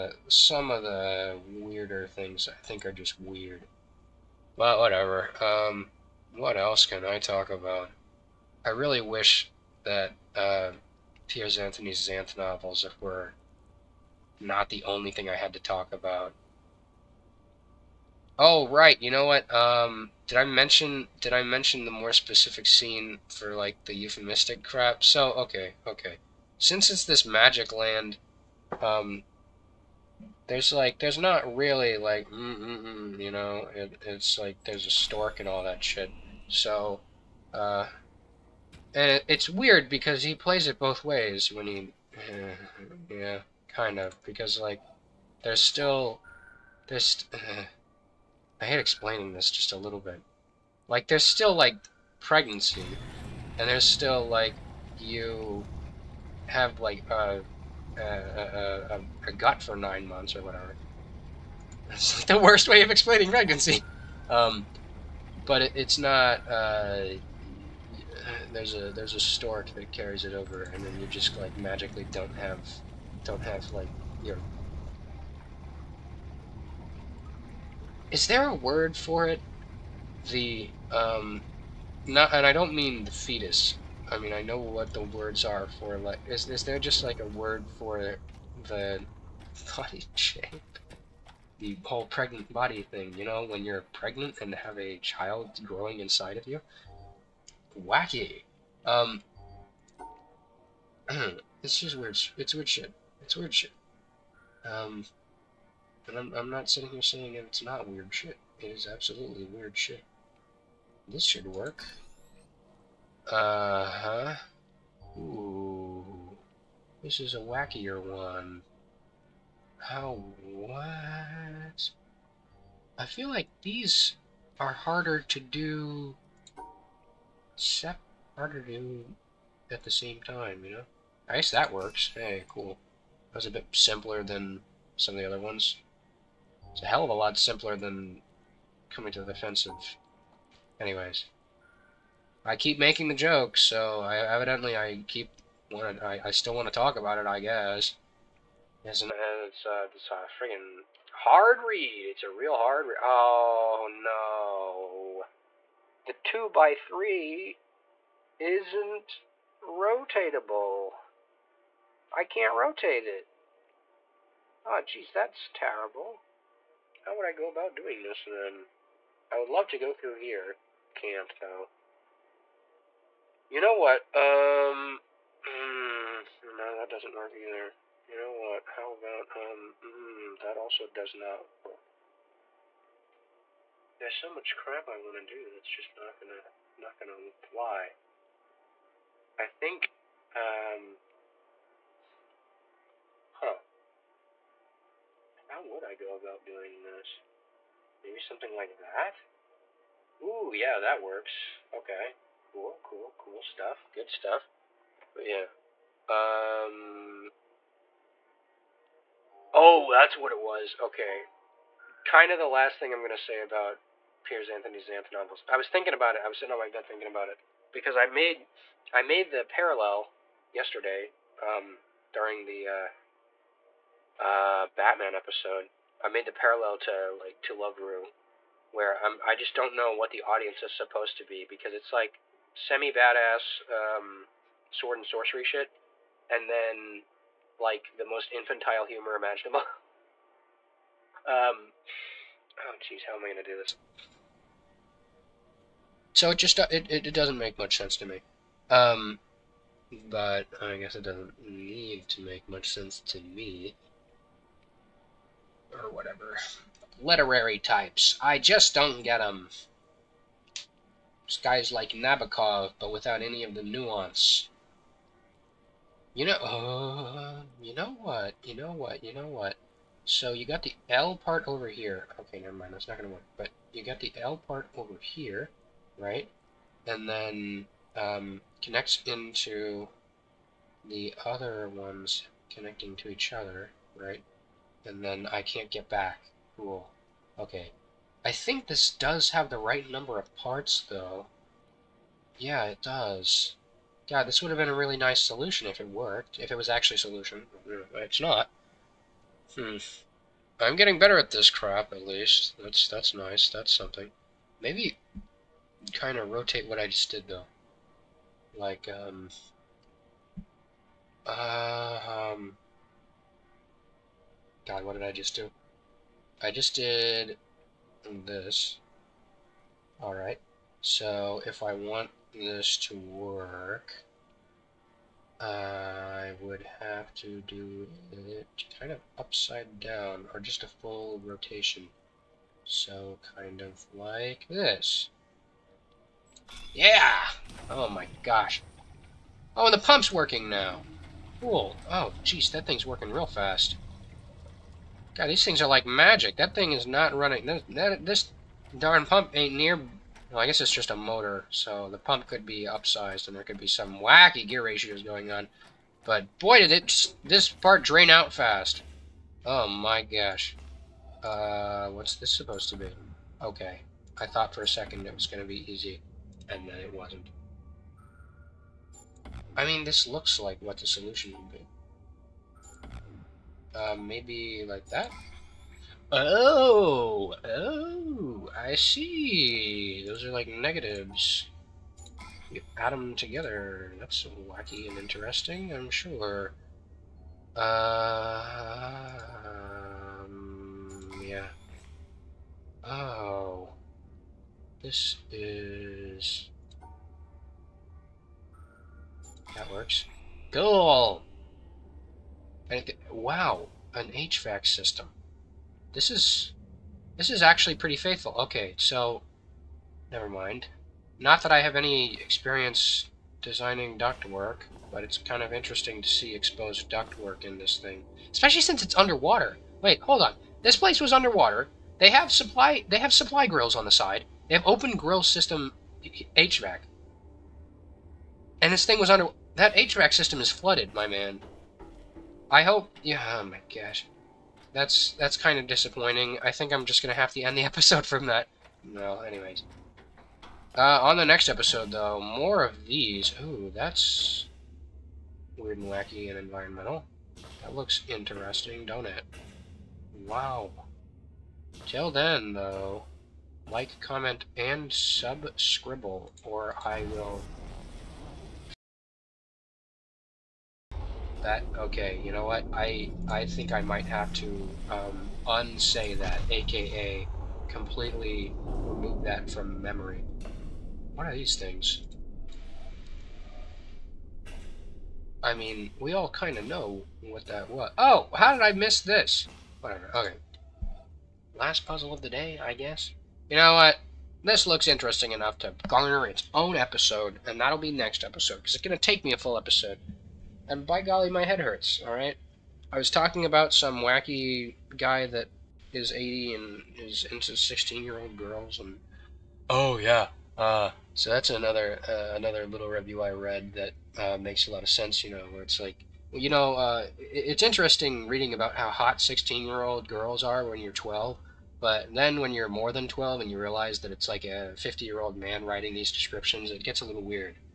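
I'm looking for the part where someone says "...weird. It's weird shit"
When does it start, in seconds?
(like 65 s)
101 s.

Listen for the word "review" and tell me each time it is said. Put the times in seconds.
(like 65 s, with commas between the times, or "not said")
502 s.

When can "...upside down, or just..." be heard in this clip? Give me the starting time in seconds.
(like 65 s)
329 s.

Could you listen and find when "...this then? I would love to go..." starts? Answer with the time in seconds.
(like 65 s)
168 s.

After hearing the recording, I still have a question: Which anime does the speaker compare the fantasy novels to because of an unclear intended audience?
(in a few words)
Love Ru.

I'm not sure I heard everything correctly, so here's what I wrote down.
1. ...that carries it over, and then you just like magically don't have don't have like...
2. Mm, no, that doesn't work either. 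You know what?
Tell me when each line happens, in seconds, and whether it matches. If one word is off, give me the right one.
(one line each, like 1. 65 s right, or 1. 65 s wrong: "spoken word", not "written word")
1. 69 s right
2. 175 s right.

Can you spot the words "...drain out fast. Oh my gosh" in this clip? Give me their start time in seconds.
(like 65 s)
357 s.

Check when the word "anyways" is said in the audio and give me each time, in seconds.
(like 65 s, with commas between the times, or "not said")
140 s, 439 s.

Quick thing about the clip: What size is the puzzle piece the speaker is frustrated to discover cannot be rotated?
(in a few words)
Two by three.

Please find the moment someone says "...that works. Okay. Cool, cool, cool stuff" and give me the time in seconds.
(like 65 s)
200 s.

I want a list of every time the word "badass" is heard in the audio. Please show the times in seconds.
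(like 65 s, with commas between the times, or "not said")
232 s.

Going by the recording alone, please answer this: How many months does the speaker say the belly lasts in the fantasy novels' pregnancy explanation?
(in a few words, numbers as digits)
9.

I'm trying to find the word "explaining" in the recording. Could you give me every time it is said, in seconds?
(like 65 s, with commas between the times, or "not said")
48 s, 62 s.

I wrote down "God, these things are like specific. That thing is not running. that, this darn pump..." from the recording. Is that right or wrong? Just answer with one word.
wrong.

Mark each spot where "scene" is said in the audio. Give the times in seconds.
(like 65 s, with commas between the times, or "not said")
22 s.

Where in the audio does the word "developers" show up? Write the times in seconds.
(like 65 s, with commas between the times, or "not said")
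not said.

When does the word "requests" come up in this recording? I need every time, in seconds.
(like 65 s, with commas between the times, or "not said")
not said.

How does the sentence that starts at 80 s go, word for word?
The um, not, and I don't mean the fetus.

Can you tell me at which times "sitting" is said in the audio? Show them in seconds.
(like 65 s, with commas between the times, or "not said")
106 s, 216 s.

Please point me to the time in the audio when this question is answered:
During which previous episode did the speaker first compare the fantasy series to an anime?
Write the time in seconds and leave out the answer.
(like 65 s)
224 s.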